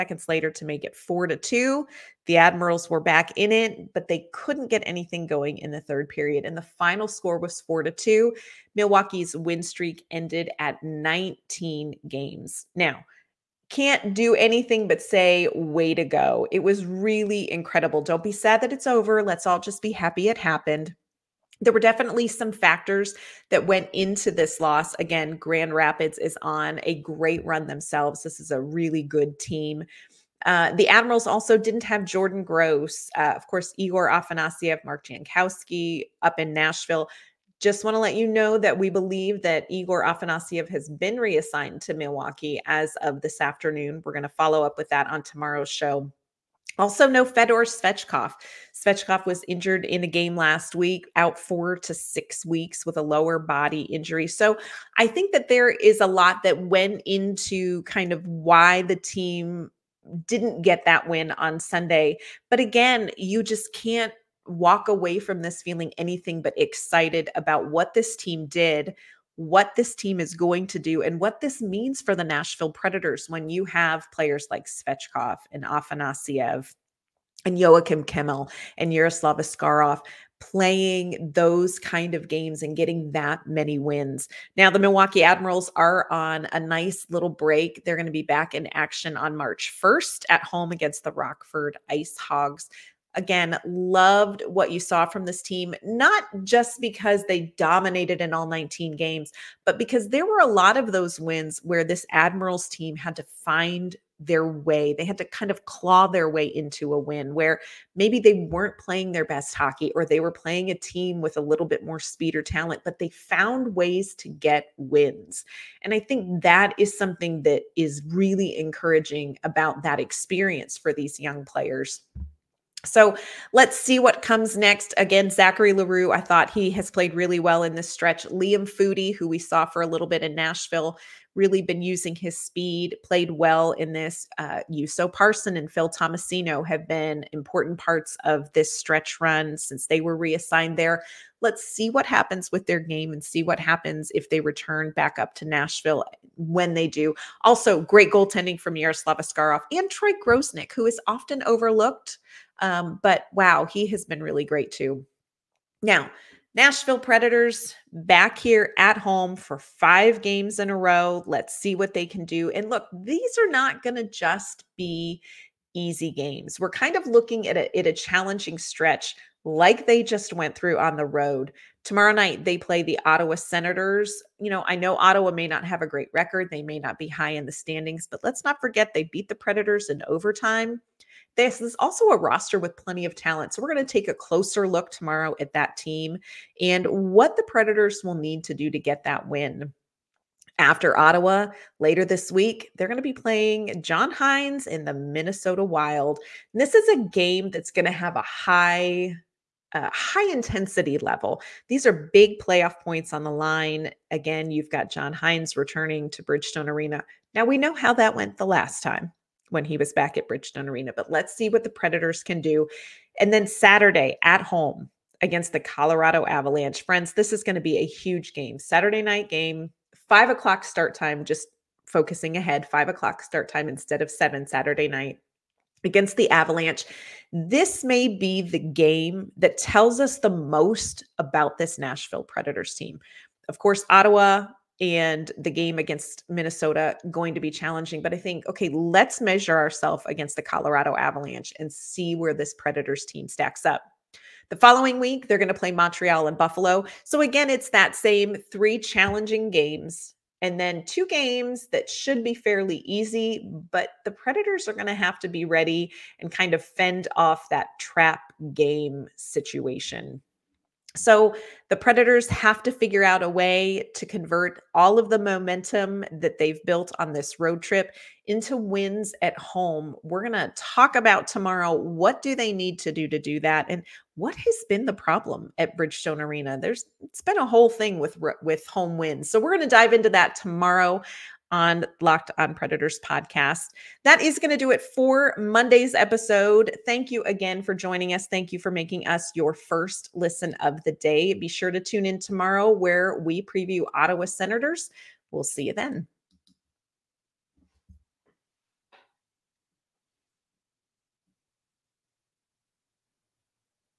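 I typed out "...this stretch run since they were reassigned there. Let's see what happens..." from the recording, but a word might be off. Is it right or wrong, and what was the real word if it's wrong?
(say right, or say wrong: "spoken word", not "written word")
right.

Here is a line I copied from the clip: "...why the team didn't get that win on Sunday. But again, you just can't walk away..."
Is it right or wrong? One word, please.
right.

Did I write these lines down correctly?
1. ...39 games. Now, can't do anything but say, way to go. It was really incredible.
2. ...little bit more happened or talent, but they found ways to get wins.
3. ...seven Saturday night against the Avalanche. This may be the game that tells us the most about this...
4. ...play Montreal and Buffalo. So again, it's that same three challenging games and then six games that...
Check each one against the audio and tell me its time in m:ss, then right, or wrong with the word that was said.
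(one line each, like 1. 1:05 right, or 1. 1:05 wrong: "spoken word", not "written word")
1. 0:10 wrong: "19", not "39"
2. 1:51 wrong: "speed", not "happened"
3. 3:44 right
4. 4:05 wrong: "two", not "six".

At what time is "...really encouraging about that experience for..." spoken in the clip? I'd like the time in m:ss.
1:58.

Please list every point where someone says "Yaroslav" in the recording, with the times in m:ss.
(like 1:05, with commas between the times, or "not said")
1:18, 2:28.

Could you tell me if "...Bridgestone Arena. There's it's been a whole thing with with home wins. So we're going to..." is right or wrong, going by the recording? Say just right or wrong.
right.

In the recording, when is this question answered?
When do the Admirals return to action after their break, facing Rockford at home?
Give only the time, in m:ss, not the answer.
1:29.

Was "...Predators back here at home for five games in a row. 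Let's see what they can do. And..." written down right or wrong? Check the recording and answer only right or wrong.
right.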